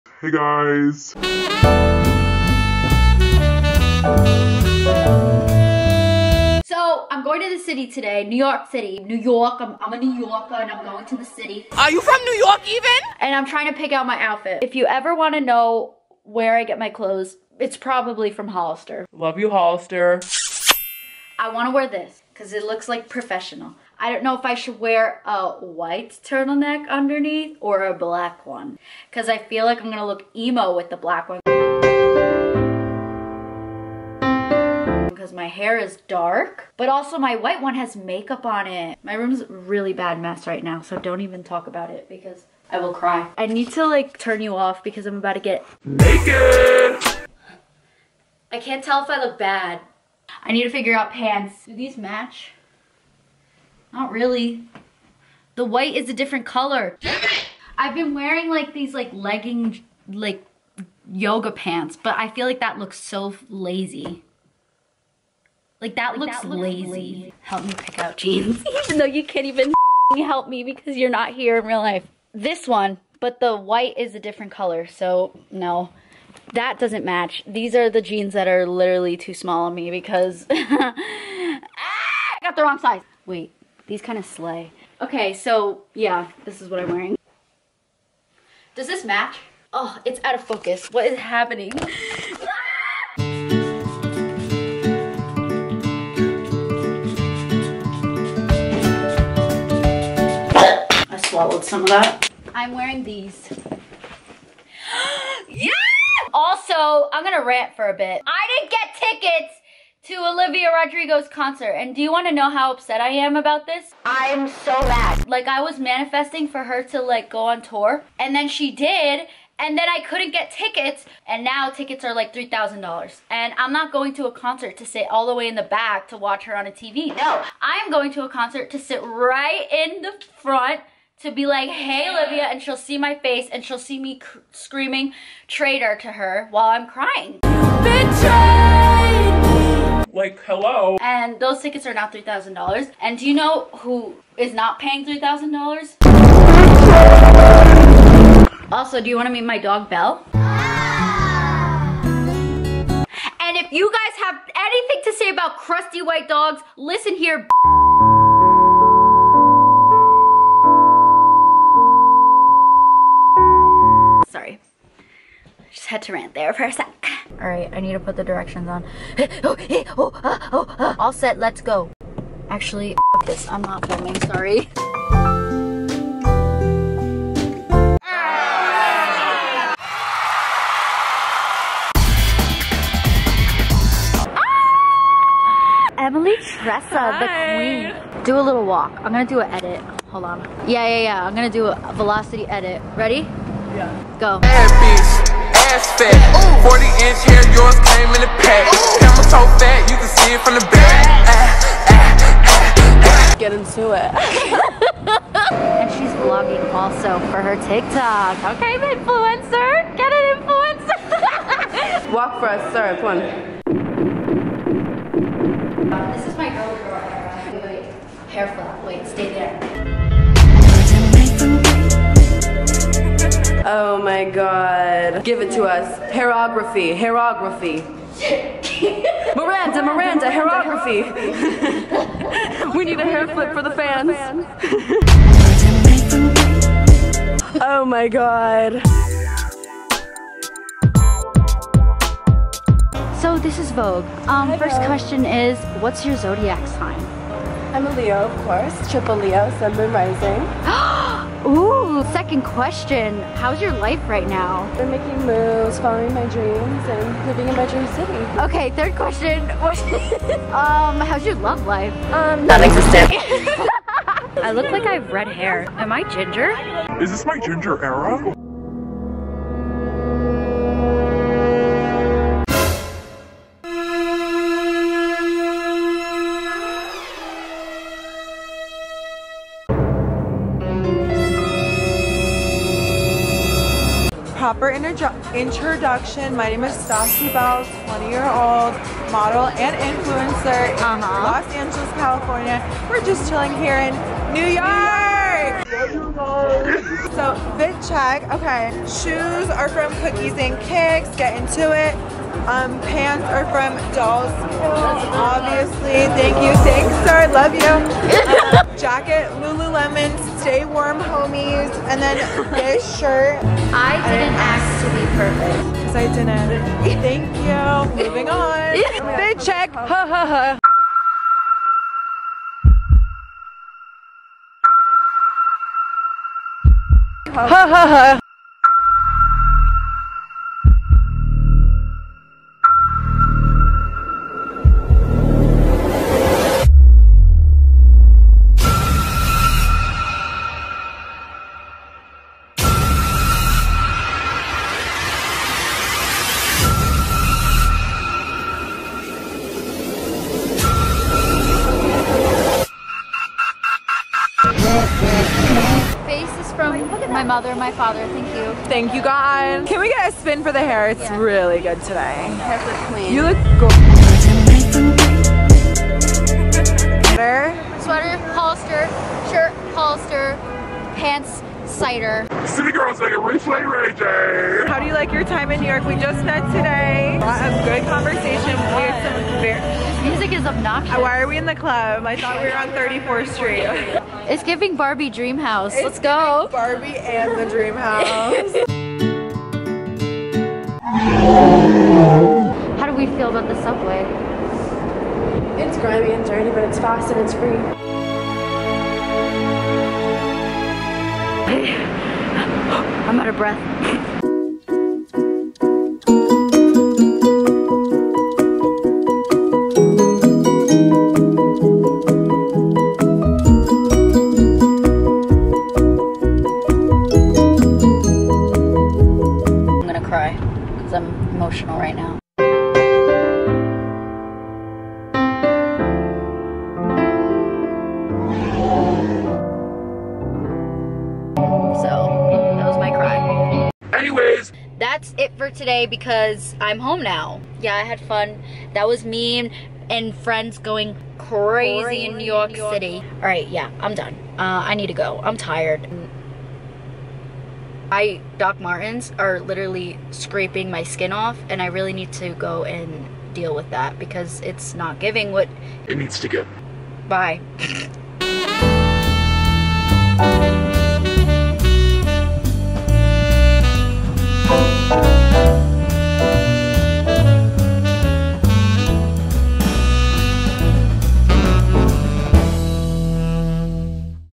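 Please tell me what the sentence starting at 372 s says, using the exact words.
City girls like a Replay, Ray J.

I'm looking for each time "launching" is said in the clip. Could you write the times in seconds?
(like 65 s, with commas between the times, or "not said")
not said.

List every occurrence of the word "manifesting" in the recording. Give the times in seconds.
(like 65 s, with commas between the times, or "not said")
115 s.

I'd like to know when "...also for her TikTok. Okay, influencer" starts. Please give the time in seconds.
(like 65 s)
206 s.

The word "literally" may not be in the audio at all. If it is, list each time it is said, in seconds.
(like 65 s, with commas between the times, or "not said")
78 s, 449 s.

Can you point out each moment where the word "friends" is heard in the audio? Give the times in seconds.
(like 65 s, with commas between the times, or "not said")
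440 s.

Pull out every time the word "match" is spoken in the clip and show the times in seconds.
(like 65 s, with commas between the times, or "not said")
51 s, 77 s, 89 s.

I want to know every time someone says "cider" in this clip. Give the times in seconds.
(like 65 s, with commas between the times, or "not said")
371 s.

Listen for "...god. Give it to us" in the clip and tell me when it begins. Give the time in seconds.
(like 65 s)
224 s.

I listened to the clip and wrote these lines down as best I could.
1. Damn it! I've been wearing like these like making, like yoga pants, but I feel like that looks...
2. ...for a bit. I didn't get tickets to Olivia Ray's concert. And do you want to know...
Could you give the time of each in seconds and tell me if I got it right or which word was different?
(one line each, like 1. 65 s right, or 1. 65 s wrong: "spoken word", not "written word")
1. 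57 s wrong: "legging", not "making"
2. 107 s wrong: "Rodrigo", not "Ray".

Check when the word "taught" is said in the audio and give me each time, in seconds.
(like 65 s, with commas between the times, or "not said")
not said.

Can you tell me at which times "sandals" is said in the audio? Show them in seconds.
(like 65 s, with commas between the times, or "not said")
not said.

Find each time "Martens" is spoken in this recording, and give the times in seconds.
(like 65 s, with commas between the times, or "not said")
448 s.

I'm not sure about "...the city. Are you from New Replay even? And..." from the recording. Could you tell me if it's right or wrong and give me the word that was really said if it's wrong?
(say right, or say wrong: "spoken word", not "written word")
wrong: "York", not "Replay".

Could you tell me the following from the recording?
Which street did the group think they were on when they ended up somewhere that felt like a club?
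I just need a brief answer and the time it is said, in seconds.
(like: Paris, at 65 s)
34th Street, at 382 s.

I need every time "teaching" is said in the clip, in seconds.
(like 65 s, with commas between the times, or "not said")
not said.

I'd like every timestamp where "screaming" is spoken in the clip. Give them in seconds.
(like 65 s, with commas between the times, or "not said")
134 s.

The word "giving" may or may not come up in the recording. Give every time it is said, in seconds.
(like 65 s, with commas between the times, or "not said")
384 s, 454 s.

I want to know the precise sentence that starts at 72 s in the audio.
This one, but the white is a different color, so no.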